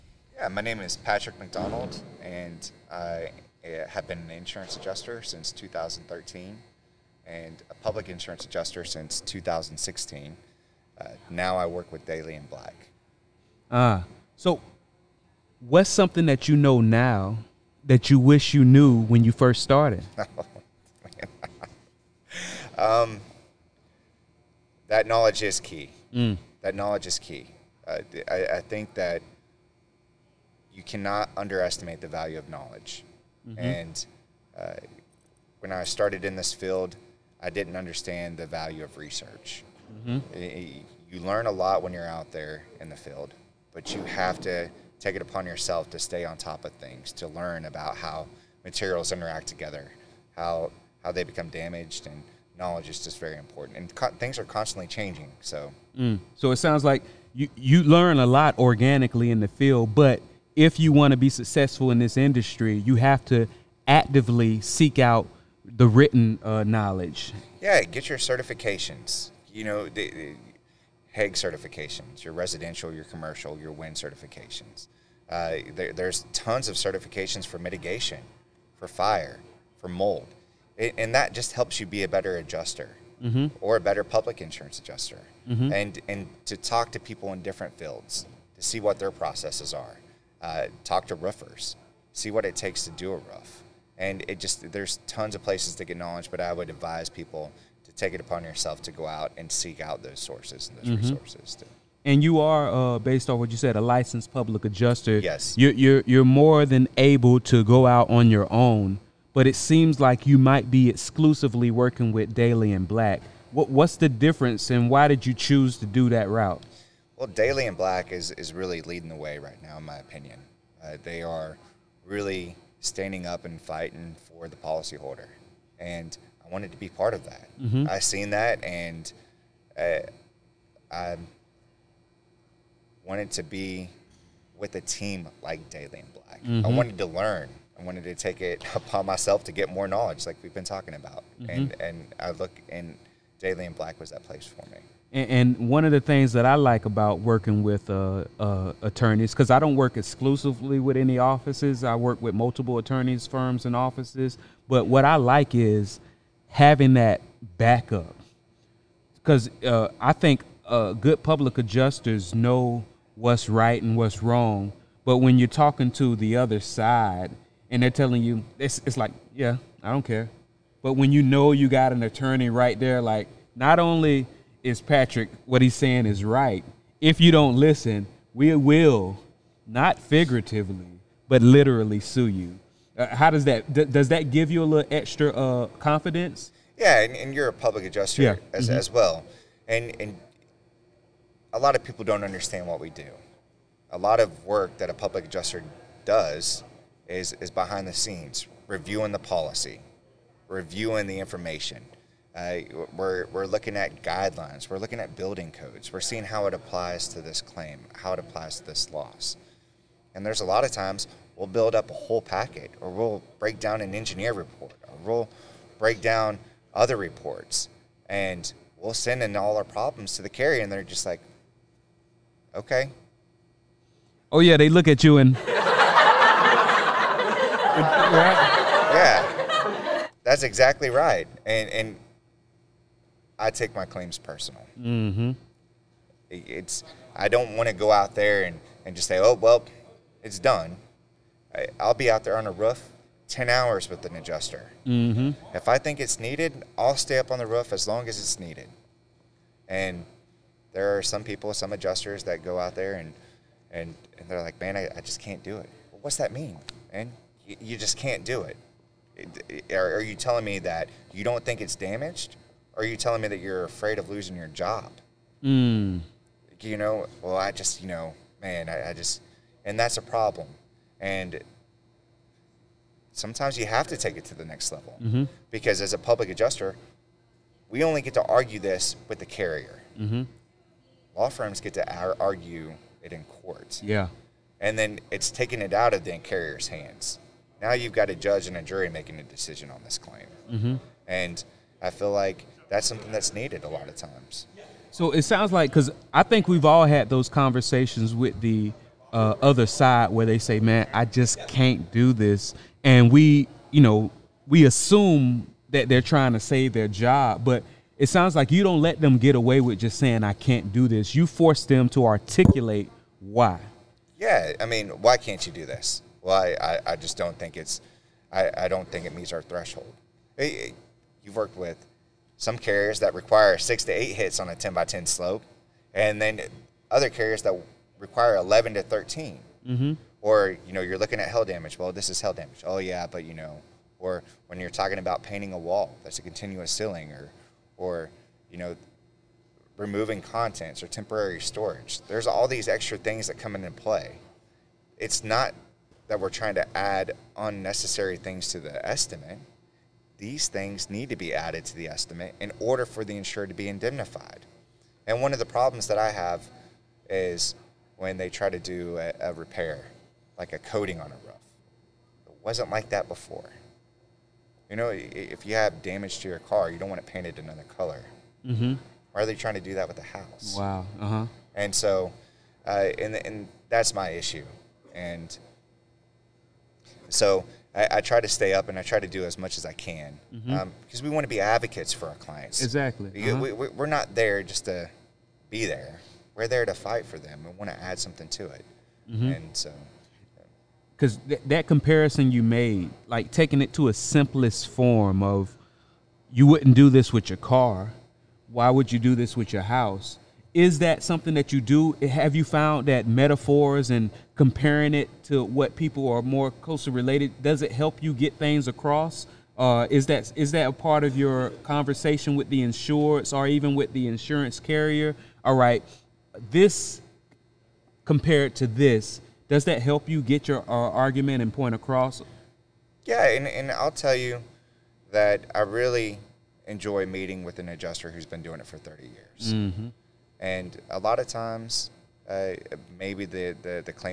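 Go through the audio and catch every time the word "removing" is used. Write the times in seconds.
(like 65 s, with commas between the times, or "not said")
339 s.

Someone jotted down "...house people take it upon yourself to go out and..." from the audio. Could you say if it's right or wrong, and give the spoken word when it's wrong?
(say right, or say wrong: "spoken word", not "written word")
wrong: "advise", not "house".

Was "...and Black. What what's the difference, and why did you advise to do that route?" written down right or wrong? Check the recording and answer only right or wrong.
wrong.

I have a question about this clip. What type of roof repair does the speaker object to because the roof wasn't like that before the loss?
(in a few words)
A coating.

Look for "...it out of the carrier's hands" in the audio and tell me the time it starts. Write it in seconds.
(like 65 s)
285 s.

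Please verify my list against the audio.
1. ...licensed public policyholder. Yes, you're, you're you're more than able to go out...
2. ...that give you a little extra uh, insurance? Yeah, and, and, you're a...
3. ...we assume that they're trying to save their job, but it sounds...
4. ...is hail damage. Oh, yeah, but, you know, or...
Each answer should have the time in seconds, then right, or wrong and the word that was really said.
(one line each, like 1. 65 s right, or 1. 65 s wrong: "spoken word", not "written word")
1. 103 s wrong: "adjuster", not "policyholder"
2. 184 s wrong: "confidence", not "insurance"
3. 304 s right
4. 332 s right.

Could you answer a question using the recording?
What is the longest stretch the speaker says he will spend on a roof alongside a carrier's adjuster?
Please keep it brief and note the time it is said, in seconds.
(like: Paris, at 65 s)
10 hours, at 243 s.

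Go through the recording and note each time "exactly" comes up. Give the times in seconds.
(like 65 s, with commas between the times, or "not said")
230 s, 382 s.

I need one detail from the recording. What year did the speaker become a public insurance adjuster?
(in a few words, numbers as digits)
2016.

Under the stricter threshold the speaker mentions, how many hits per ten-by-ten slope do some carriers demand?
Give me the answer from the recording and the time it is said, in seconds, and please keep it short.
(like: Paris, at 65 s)
11 to 13, at 328 s.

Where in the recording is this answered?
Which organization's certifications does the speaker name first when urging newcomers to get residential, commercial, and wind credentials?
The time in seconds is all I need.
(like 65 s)
71 s.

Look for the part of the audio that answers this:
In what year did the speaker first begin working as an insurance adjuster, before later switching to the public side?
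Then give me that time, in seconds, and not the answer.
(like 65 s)
5 s.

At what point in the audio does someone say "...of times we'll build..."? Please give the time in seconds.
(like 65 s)
210 s.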